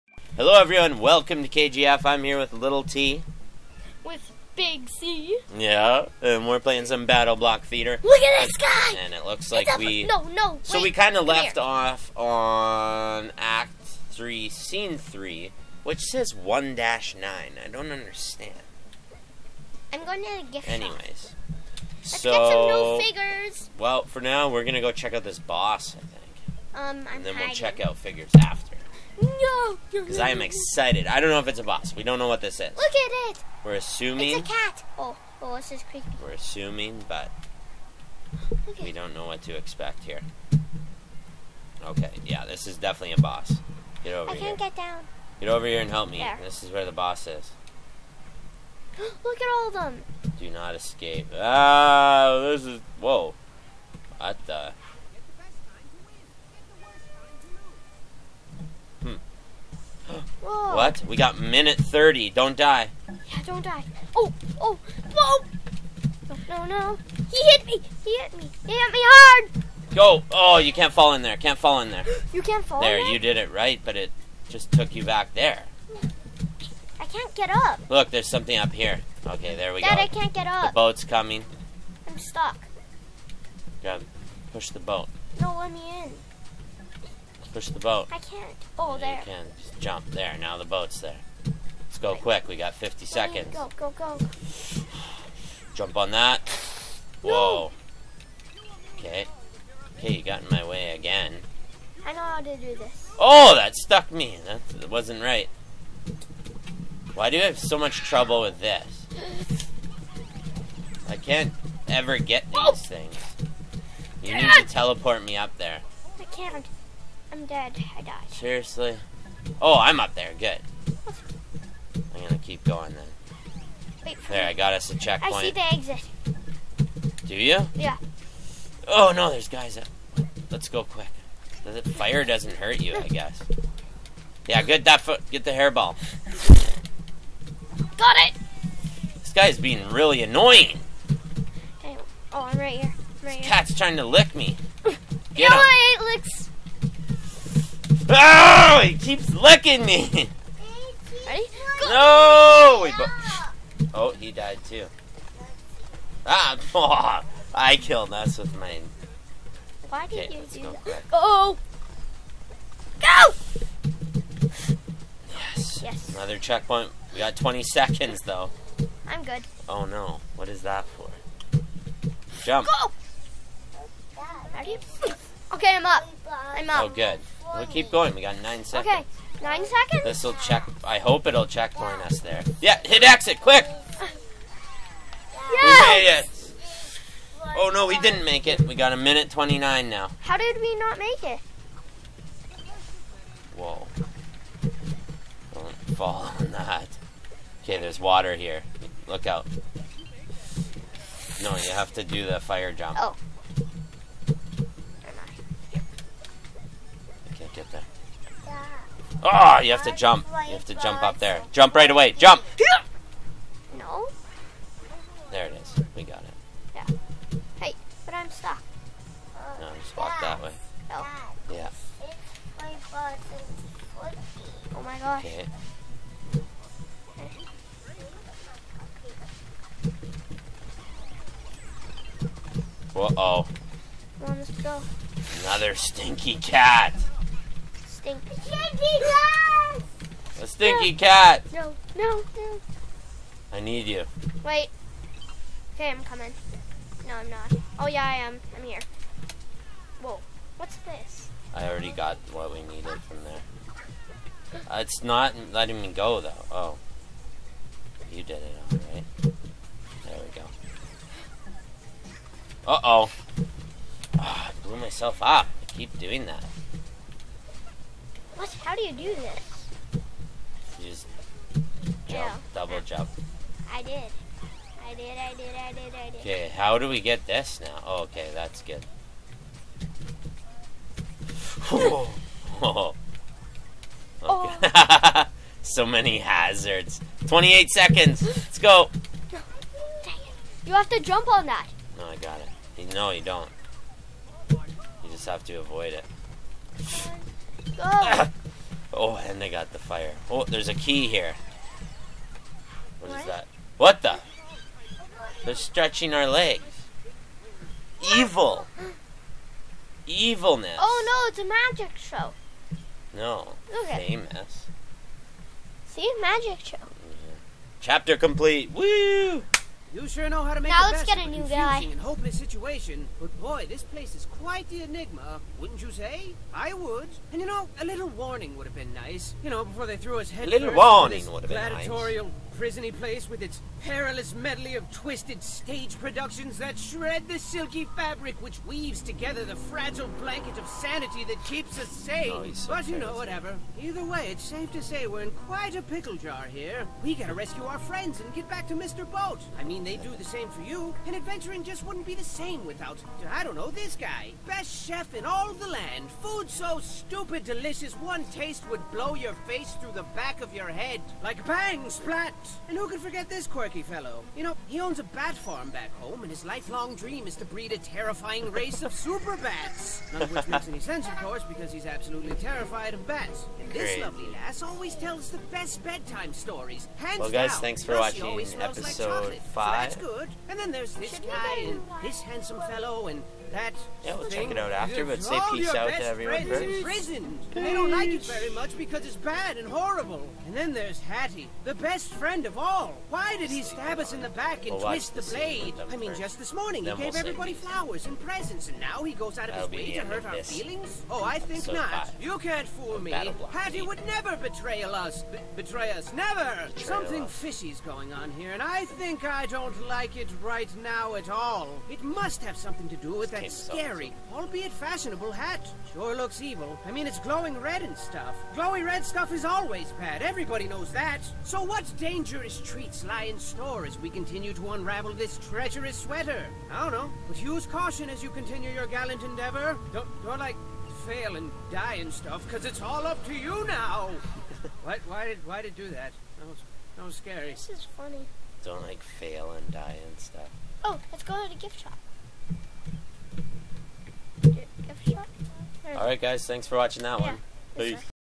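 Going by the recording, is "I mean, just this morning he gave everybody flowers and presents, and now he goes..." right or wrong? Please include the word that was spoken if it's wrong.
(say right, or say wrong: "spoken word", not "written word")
right.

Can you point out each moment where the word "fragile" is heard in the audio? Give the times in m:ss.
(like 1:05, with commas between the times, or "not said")
5:39.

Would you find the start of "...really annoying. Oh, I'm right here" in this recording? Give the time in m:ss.
2:19.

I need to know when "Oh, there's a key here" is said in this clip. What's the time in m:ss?
5:00.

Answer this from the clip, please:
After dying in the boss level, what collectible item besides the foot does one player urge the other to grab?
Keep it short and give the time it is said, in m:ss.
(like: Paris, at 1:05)
The hairball, at 2:15.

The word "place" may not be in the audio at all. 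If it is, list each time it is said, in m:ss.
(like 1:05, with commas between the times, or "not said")
5:23, 5:32.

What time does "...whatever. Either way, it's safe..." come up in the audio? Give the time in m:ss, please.
5:43.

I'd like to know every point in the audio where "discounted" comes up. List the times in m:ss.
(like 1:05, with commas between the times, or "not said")
not said.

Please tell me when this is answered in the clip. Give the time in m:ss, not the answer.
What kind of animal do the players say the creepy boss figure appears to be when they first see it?
0:34.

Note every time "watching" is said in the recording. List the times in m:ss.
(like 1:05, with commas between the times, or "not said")
6:18, 7:26.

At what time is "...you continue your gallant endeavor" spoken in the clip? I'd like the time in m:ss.
7:08.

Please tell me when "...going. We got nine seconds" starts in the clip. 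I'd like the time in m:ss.
2:57.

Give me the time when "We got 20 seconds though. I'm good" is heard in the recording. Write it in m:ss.
2:47.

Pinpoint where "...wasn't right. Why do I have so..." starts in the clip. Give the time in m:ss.
1:44.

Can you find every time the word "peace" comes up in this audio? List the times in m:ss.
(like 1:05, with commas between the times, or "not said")
6:25, 7:27.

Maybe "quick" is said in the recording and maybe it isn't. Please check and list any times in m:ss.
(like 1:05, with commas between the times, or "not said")
1:32, 2:10, 3:03.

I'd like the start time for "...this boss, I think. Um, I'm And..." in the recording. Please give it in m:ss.
0:25.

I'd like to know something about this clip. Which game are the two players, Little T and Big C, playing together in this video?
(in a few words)
BattleBlock Theater.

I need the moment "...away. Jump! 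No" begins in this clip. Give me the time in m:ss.
3:31.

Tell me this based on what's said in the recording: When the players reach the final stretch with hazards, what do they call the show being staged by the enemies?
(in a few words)
A magic show.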